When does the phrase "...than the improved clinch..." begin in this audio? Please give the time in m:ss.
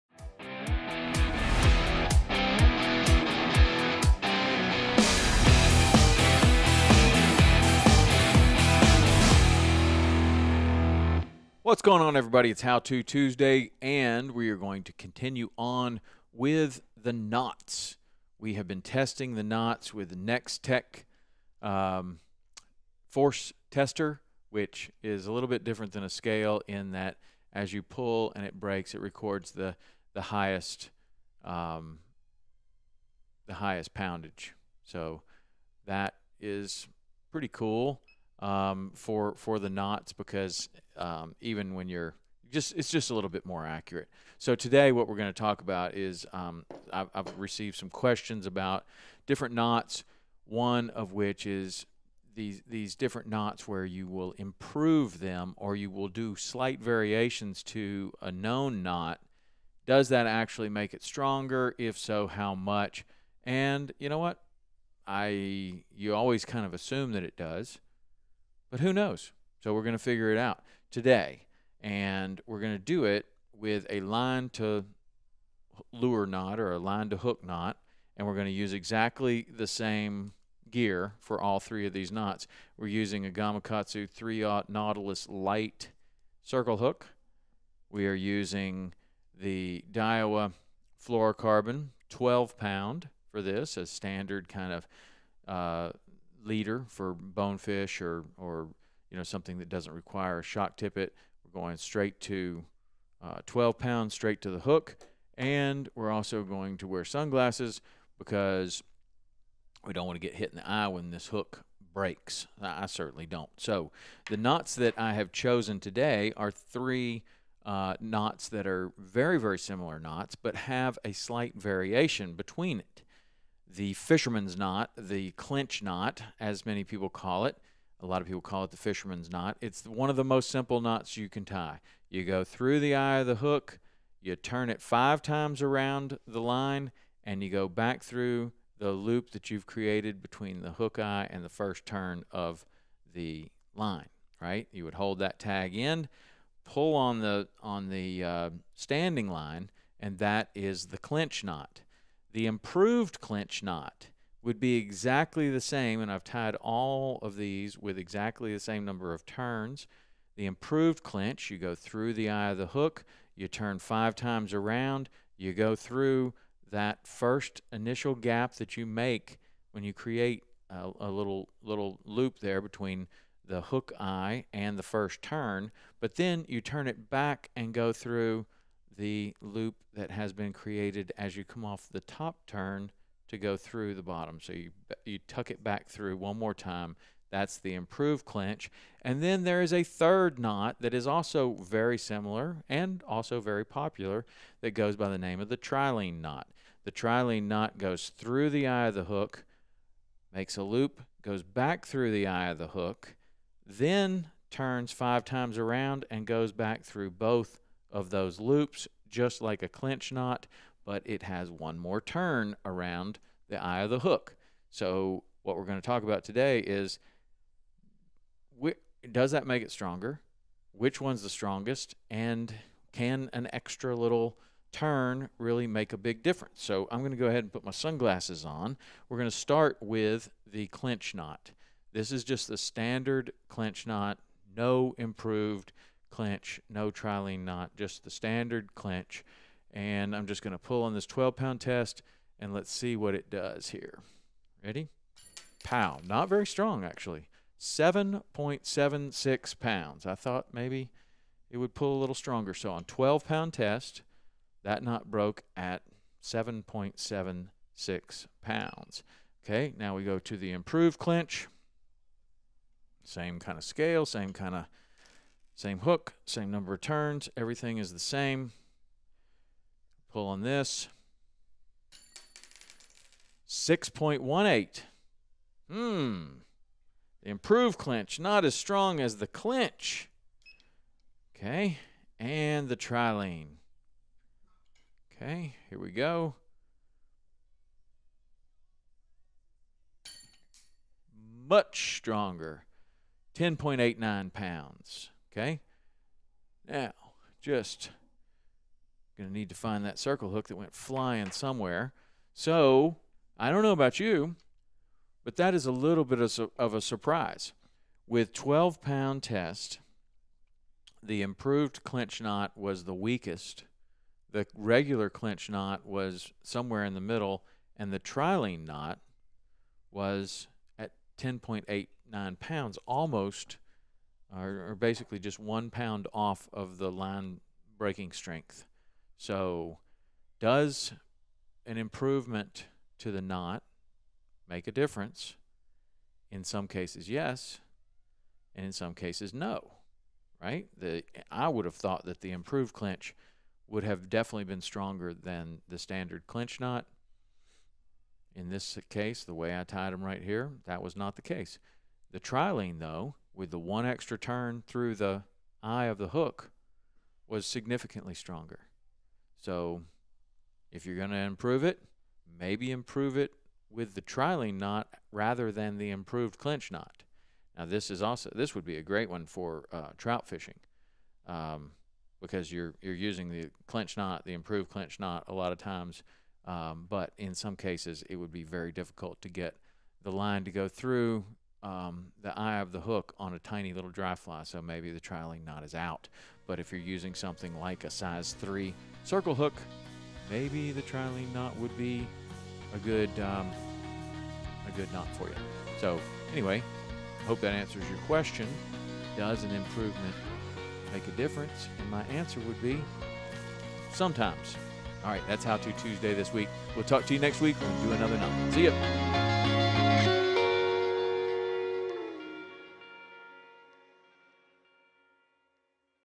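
6:05.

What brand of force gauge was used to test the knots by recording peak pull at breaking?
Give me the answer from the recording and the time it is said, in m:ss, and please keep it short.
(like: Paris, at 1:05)
Next Tech, at 0:20.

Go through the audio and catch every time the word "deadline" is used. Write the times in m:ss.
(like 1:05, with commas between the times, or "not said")
not said.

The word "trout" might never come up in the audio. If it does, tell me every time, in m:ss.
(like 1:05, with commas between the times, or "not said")
6:09.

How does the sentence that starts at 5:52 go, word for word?
The trilene, though, with the one extra turn through the eye of the hook was significantly stronger.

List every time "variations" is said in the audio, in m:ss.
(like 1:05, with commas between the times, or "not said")
0:56, 2:01.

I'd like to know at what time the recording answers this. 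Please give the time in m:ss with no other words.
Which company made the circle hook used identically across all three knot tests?
1:23.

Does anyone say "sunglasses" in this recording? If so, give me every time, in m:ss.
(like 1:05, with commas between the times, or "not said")
1:47, 3:47.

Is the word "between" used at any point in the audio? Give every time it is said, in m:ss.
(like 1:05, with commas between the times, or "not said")
2:02, 2:20, 2:52.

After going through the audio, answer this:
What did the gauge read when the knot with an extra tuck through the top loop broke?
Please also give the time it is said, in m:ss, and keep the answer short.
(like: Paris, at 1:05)
6.18, at 4:33.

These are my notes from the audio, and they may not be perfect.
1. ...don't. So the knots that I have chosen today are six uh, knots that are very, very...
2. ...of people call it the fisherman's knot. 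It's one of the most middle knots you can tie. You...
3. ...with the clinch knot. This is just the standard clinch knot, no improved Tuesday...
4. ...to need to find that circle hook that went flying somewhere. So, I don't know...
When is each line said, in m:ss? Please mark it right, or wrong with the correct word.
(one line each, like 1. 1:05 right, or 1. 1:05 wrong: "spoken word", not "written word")
1. 1:53 wrong: "three", not "six"
2. 2:08 wrong: "simple", not "middle"
3. 3:49 wrong: "Clinch", not "Tuesday"
4. 4:59 right.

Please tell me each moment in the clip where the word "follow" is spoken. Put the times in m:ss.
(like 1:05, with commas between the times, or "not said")
not said.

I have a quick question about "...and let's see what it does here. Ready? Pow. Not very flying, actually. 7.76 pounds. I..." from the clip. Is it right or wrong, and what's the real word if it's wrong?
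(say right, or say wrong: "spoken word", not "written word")
wrong: "strong", not "flying".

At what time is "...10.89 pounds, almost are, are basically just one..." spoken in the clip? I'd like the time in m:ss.
5:21.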